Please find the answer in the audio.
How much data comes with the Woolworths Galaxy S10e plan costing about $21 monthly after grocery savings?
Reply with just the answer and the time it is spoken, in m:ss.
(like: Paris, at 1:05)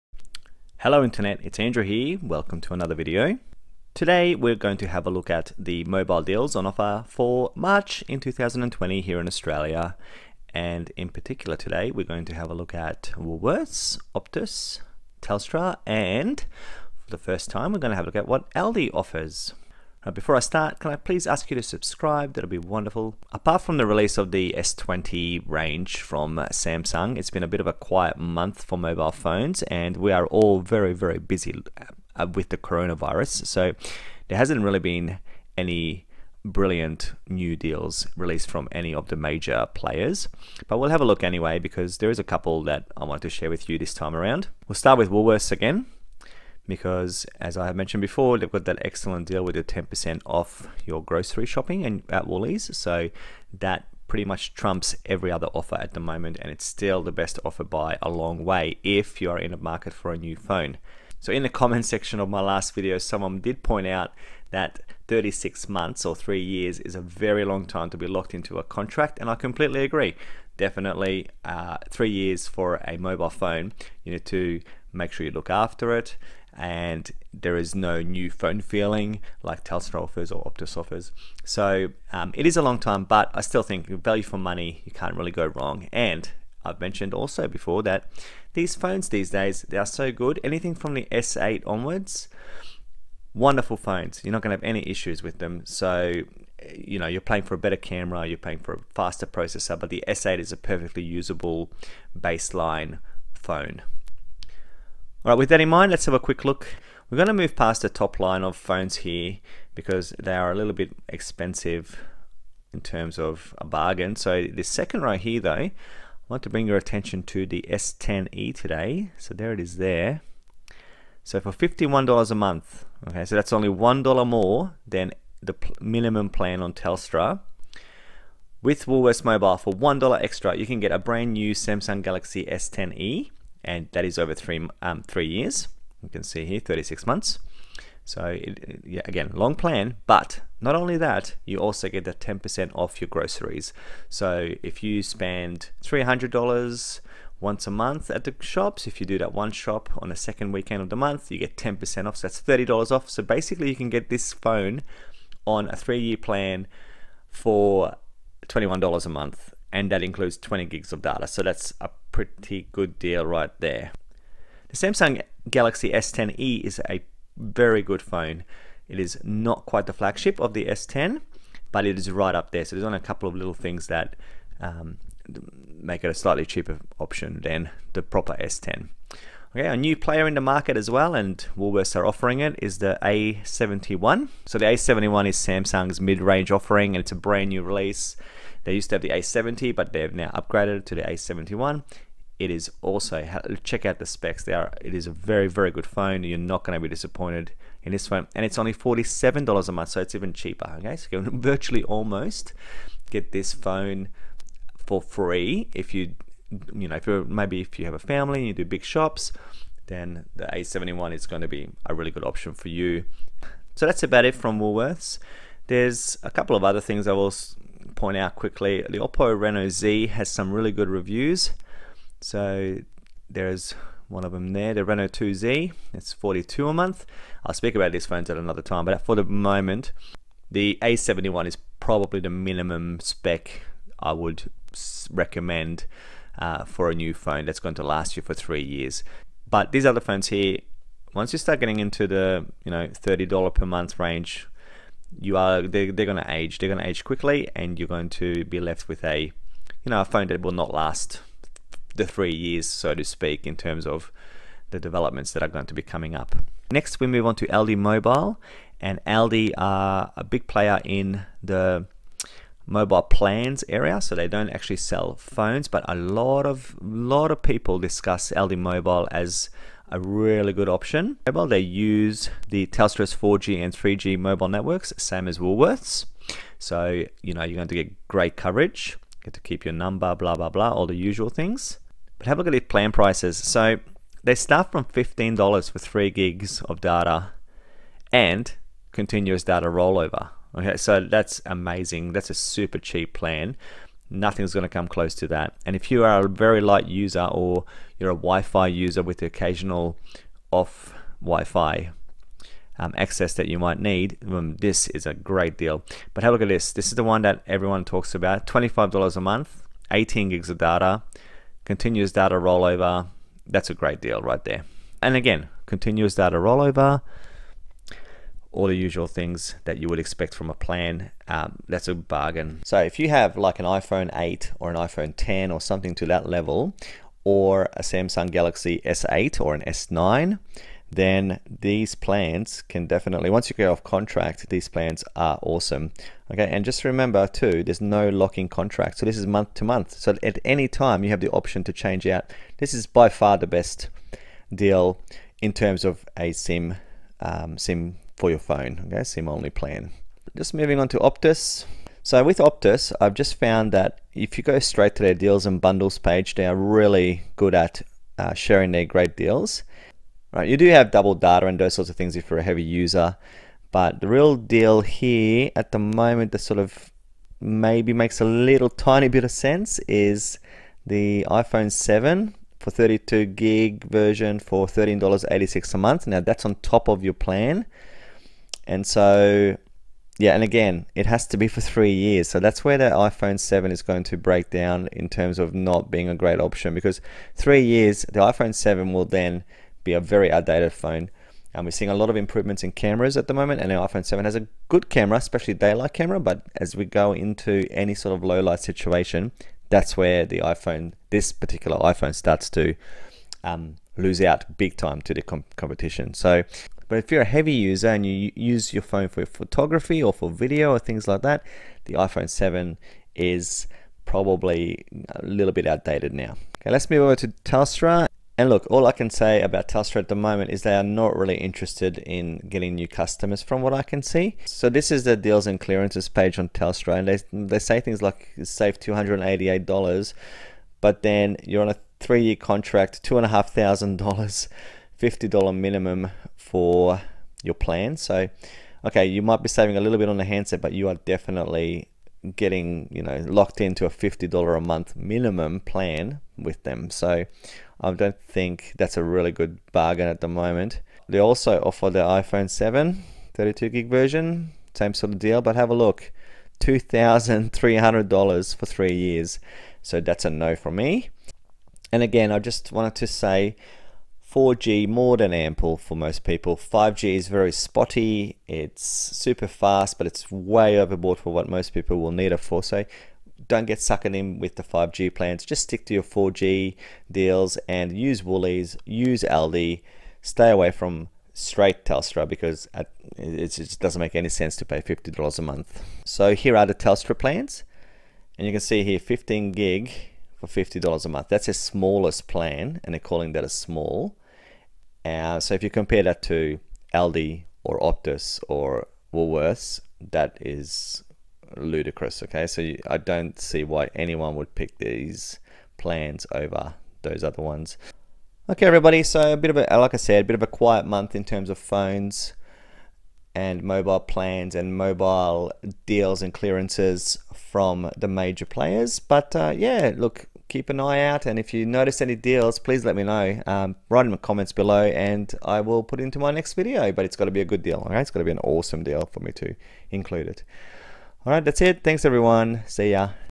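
20 gigs, at 2:40.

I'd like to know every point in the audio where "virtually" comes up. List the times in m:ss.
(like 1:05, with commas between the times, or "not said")
3:21.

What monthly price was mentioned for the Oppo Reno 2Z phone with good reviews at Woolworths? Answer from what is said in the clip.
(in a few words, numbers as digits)
42.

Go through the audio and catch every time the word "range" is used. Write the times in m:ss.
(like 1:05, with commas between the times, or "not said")
0:25, 3:05, 4:03.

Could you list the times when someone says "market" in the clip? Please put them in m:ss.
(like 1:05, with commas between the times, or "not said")
0:59, 3:00.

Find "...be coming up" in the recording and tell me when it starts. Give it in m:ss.
4:15.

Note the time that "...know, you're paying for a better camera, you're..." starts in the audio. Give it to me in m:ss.
1:36.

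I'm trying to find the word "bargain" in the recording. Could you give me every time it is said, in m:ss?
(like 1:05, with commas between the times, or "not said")
1:53, 5:21, 7:29.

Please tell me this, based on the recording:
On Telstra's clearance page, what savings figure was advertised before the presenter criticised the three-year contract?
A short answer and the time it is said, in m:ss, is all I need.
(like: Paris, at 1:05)
$288, at 7:08.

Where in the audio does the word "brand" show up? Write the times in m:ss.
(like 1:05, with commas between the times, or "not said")
2:10, 3:07.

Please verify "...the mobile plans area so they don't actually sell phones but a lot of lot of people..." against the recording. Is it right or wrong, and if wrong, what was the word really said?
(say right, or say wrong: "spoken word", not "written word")
right.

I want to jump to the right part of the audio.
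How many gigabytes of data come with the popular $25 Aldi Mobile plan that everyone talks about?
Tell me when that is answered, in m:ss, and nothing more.
5:09.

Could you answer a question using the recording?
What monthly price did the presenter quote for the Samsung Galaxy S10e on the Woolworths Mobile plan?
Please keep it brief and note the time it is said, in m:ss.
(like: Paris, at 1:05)
$51, at 2:01.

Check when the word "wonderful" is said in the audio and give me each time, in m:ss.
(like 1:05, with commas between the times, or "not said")
0:22, 1:33.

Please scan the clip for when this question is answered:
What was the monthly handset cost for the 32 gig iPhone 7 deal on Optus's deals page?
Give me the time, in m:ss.
6:14.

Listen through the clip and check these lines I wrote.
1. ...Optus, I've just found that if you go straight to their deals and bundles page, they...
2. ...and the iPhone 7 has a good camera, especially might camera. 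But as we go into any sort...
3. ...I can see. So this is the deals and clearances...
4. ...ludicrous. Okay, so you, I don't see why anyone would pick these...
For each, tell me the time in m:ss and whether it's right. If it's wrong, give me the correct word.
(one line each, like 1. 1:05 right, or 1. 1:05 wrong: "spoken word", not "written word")
1. 5:52 right
2. 6:33 wrong: "daylight", not "might"
3. 7:03 right
4. 8:21 right.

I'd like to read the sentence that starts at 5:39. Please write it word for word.
So at any time you have the option to change out.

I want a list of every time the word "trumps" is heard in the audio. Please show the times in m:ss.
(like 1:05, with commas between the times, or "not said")
0:54.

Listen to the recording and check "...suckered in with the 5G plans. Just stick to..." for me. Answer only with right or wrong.
right.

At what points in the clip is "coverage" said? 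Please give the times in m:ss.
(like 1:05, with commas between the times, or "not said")
4:38.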